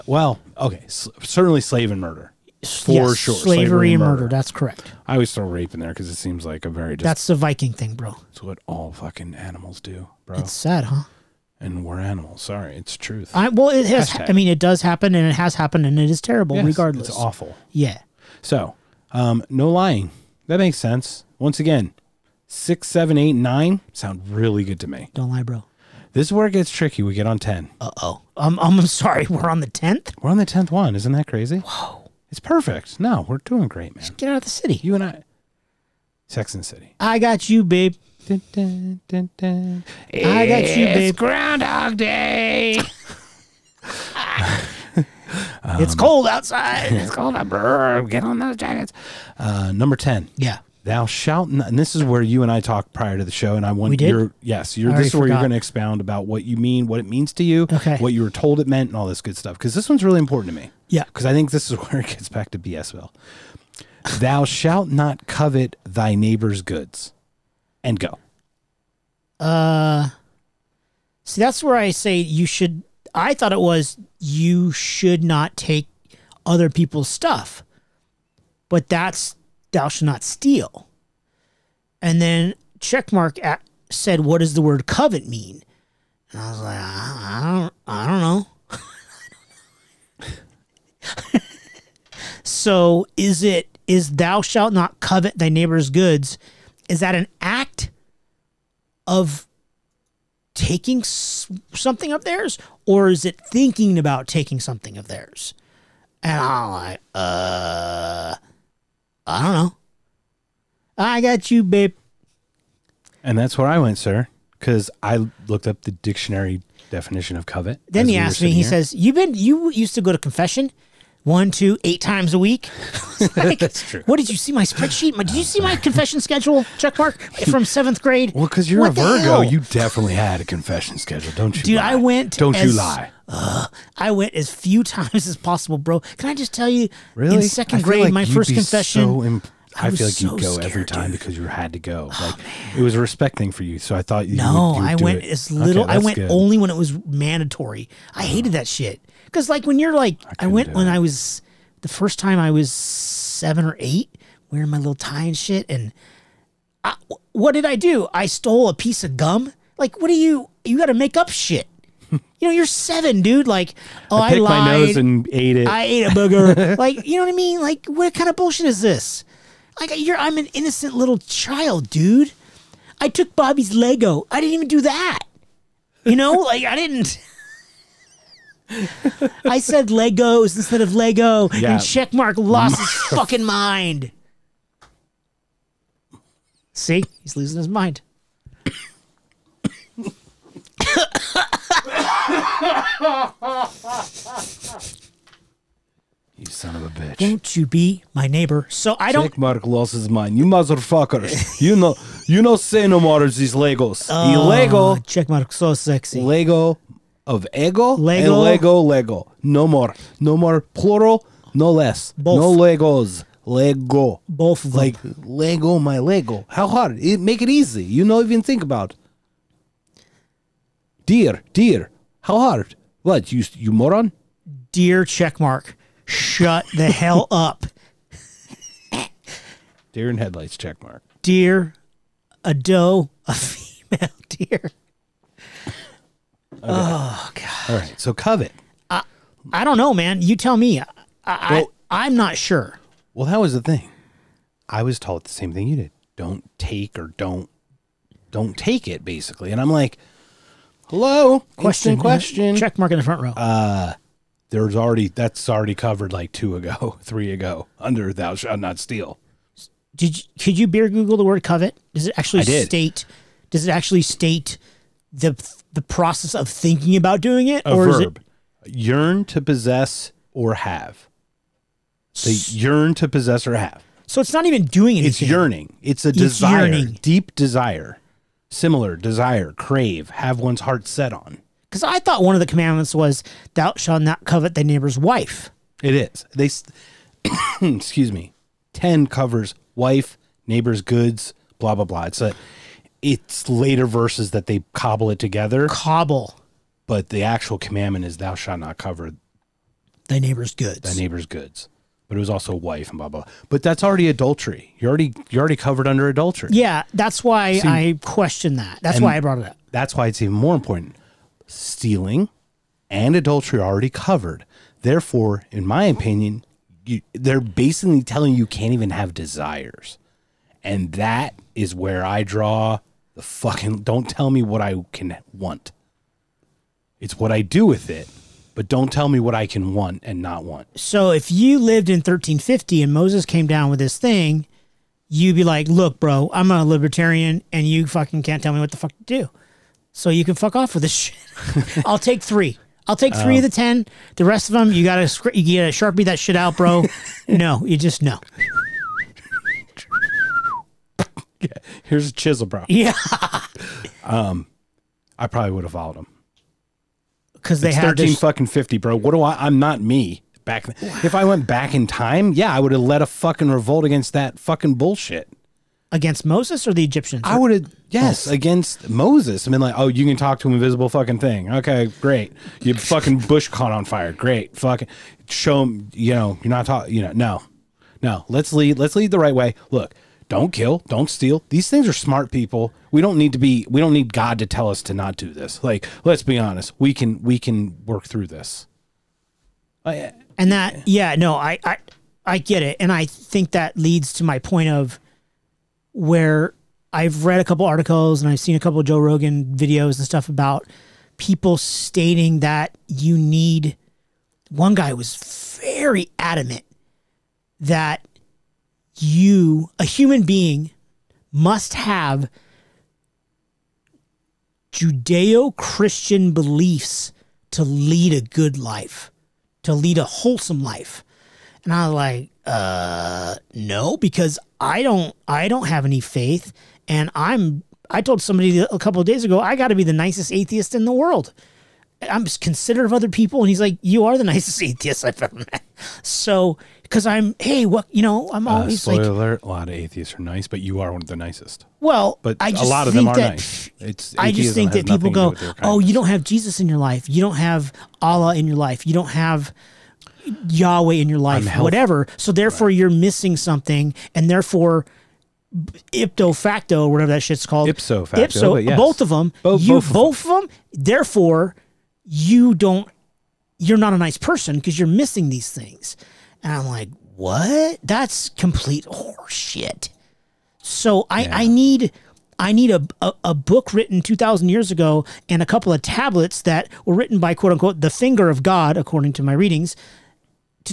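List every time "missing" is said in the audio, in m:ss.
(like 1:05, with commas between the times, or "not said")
7:32, 7:44.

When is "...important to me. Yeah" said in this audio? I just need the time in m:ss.
1:00.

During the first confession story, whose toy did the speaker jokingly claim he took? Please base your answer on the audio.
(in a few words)
Bobby's.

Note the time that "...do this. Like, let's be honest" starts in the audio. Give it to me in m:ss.
6:25.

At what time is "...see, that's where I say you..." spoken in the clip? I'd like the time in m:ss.
1:11.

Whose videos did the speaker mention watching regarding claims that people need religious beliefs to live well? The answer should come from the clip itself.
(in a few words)
Joe Rogan.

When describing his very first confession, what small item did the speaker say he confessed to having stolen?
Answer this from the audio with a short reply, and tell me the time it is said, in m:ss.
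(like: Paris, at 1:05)
a piece of gum, at 2:38.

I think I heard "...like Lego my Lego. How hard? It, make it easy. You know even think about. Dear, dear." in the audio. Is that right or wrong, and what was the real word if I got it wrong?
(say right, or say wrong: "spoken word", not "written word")
right.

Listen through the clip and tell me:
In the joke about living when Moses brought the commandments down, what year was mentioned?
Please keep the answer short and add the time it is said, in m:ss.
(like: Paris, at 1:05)
1350, at 5:31.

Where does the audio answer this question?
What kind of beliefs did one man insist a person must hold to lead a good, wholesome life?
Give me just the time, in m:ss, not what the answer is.
6:54.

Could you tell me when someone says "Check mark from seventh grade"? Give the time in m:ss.
2:06.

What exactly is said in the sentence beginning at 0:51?
And this is where you and I talked prior to the show, and I want your yes.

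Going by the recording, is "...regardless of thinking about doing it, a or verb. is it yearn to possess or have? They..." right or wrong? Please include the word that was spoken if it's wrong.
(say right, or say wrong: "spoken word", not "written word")
wrong: "process", not "regardless".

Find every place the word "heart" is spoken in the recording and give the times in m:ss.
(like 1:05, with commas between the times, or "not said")
4:40.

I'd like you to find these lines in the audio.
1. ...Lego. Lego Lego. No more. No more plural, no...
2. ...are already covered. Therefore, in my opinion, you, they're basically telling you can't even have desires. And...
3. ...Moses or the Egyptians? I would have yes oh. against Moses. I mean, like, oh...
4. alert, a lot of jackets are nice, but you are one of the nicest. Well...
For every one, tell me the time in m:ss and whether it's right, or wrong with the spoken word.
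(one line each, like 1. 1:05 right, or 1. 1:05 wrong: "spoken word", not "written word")
1. 3:27 right
2. 5:13 right
3. 6:06 right
4. 7:19 wrong: "atheists", not "jackets".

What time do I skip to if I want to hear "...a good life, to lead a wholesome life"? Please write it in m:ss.
6:58.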